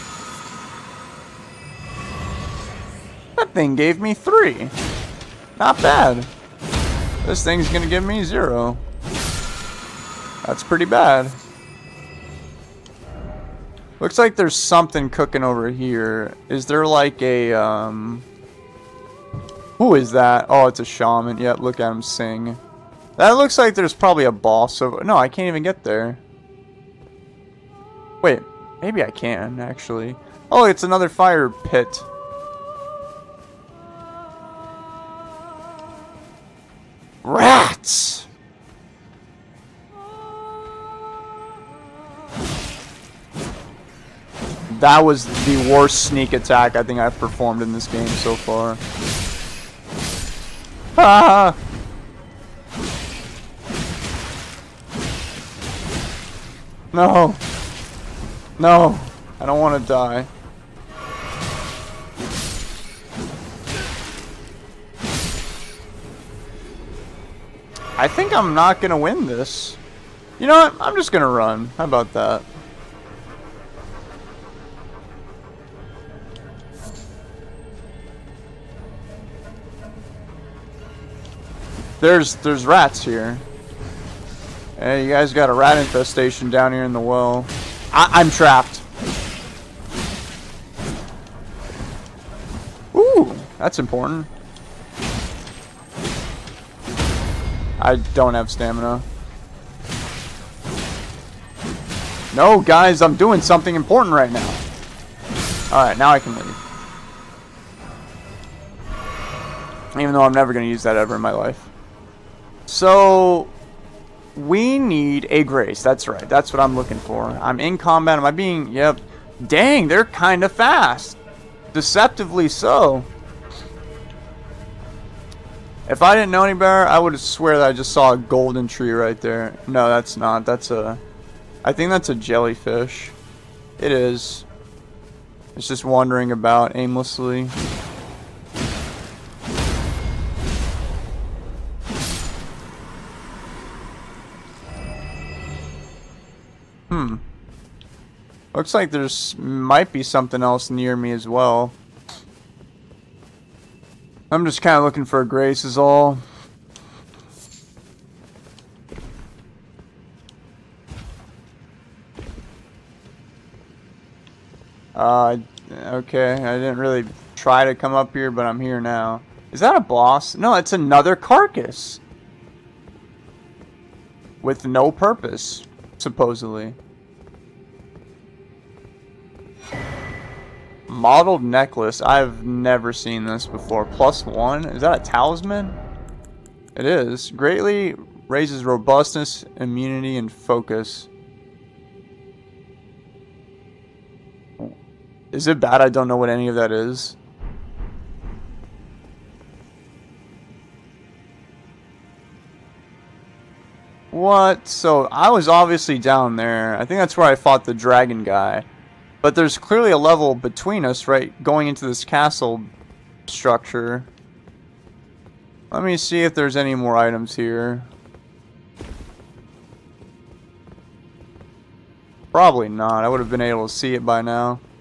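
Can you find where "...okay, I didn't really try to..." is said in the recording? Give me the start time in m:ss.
2:45.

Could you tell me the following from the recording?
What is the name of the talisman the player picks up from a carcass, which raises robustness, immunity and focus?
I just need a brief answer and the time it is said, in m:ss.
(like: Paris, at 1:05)
Mottled necklace, at 3:00.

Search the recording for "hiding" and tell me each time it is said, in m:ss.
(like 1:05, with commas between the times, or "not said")
not said.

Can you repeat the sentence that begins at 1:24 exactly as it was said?
Hey, you guys got a rat infestation down here in the well.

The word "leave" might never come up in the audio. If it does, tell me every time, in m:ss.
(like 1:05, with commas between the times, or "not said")
1:46.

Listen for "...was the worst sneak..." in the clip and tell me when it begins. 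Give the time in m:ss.
0:45.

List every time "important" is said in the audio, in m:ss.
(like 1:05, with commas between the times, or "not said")
1:33, 1:43.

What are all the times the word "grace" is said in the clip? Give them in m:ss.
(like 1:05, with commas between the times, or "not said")
1:55, 2:35.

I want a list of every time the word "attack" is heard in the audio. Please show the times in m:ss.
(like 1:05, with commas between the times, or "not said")
0:46.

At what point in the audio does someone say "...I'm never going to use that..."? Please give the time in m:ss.
1:50.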